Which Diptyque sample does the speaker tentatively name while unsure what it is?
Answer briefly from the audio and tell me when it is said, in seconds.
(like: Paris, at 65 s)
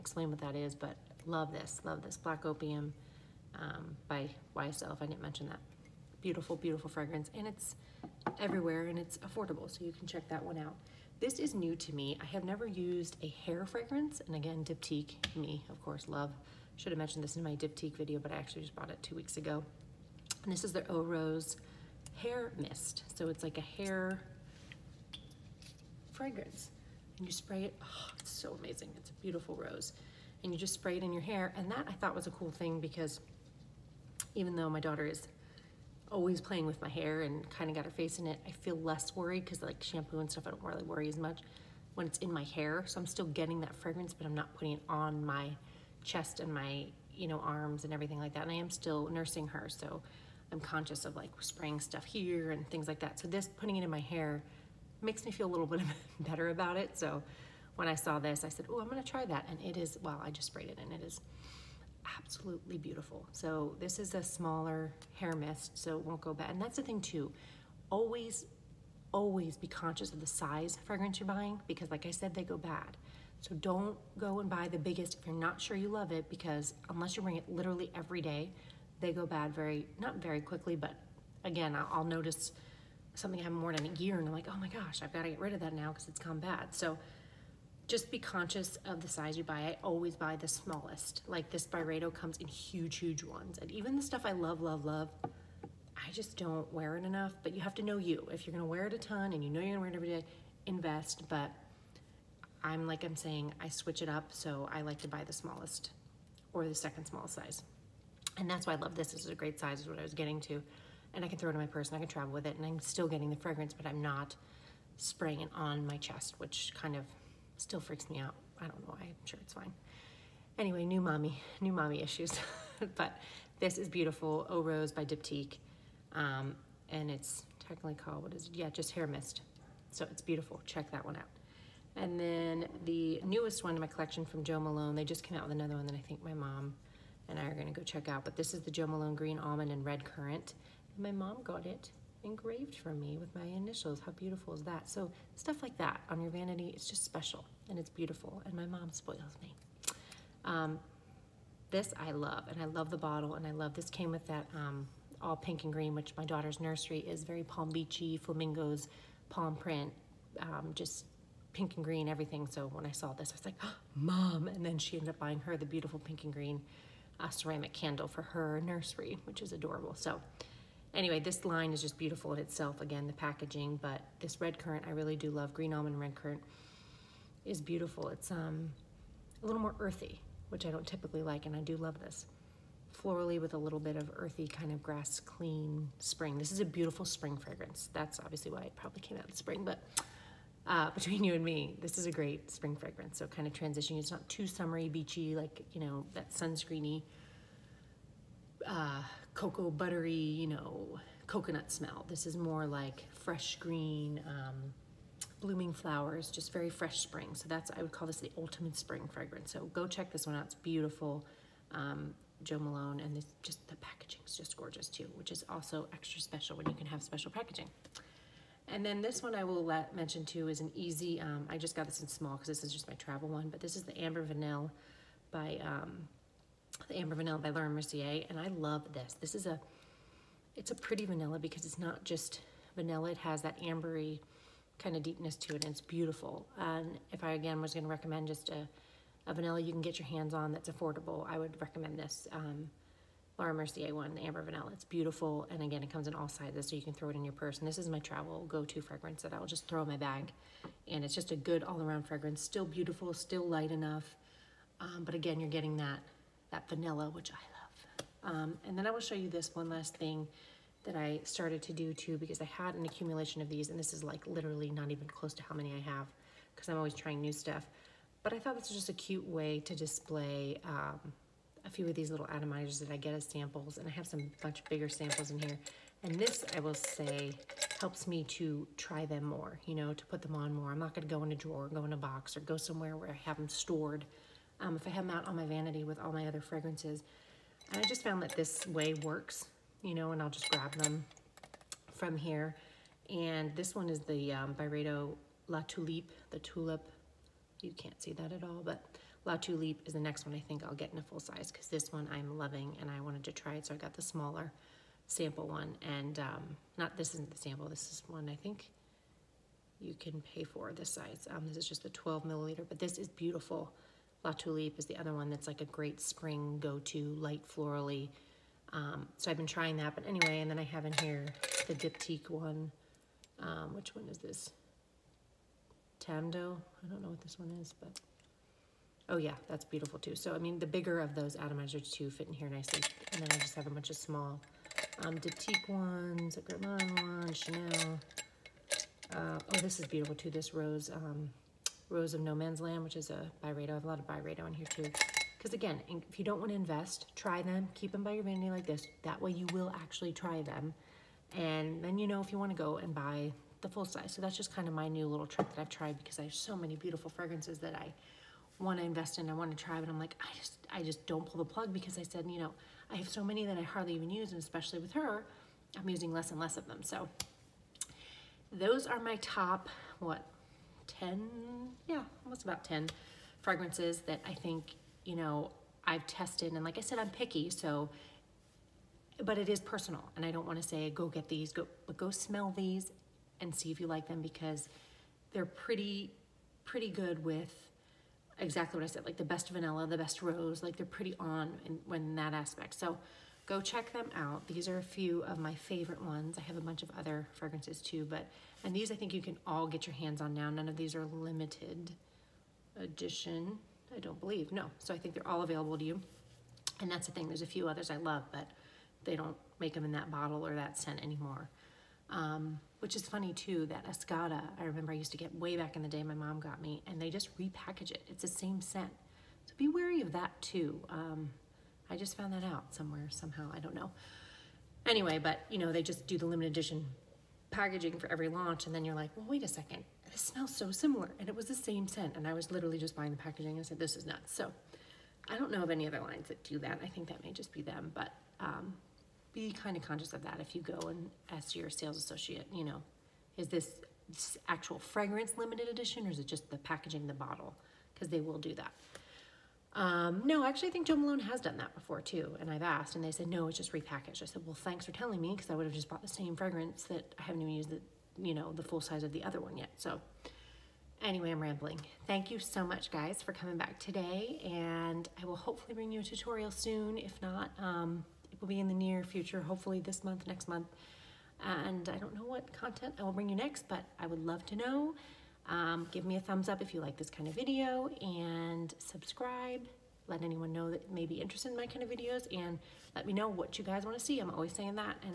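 Tam Dao, at 325 s.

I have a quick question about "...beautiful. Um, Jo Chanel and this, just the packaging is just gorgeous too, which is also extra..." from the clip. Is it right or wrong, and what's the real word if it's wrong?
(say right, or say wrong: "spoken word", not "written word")
wrong: "Malone", not "Chanel".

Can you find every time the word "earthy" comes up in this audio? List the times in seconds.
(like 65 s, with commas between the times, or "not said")
179 s, 184 s.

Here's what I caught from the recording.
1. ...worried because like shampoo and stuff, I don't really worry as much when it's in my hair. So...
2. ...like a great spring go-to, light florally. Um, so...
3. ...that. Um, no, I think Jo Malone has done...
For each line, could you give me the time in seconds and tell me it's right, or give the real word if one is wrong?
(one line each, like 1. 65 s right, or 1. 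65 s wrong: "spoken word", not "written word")
1. 39 s right
2. 315 s right
3. 448 s right.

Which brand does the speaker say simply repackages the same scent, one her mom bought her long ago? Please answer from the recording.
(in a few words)
Escada.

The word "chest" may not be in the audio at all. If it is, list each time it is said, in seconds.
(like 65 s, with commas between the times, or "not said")
46 s, 115 s.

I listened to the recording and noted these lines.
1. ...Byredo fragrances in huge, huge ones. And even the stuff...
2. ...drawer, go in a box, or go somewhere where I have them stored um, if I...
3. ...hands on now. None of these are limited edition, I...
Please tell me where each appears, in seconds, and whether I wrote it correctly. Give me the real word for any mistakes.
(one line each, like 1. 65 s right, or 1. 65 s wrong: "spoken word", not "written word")
1. 91 s wrong: "comes", not "fragrances"
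2. 281 s right
3. 399 s right.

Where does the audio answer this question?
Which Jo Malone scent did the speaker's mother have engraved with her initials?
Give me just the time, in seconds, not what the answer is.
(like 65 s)
139 s.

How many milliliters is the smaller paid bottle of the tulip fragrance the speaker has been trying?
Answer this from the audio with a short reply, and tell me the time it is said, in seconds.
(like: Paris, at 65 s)
12, at 311 s.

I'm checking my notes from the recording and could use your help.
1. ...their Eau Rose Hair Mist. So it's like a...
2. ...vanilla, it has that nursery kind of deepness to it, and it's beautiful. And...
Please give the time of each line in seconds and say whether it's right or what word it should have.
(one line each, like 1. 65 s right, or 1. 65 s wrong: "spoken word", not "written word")
1. 20 s right
2. 232 s wrong: "ambery", not "nursery".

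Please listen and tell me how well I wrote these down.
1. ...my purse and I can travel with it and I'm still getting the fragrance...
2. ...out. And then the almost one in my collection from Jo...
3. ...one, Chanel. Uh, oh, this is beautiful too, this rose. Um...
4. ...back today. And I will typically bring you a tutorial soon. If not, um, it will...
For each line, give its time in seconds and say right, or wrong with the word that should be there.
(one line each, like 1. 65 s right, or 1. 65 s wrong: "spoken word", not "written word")
1. 111 s right
2. 131 s wrong: "newest", not "almost"
3. 337 s right
4. 463 s wrong: "hopefully", not "typically".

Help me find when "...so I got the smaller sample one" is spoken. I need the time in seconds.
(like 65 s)
303 s.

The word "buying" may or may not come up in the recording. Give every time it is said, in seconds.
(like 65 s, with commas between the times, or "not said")
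71 s, 165 s, 432 s.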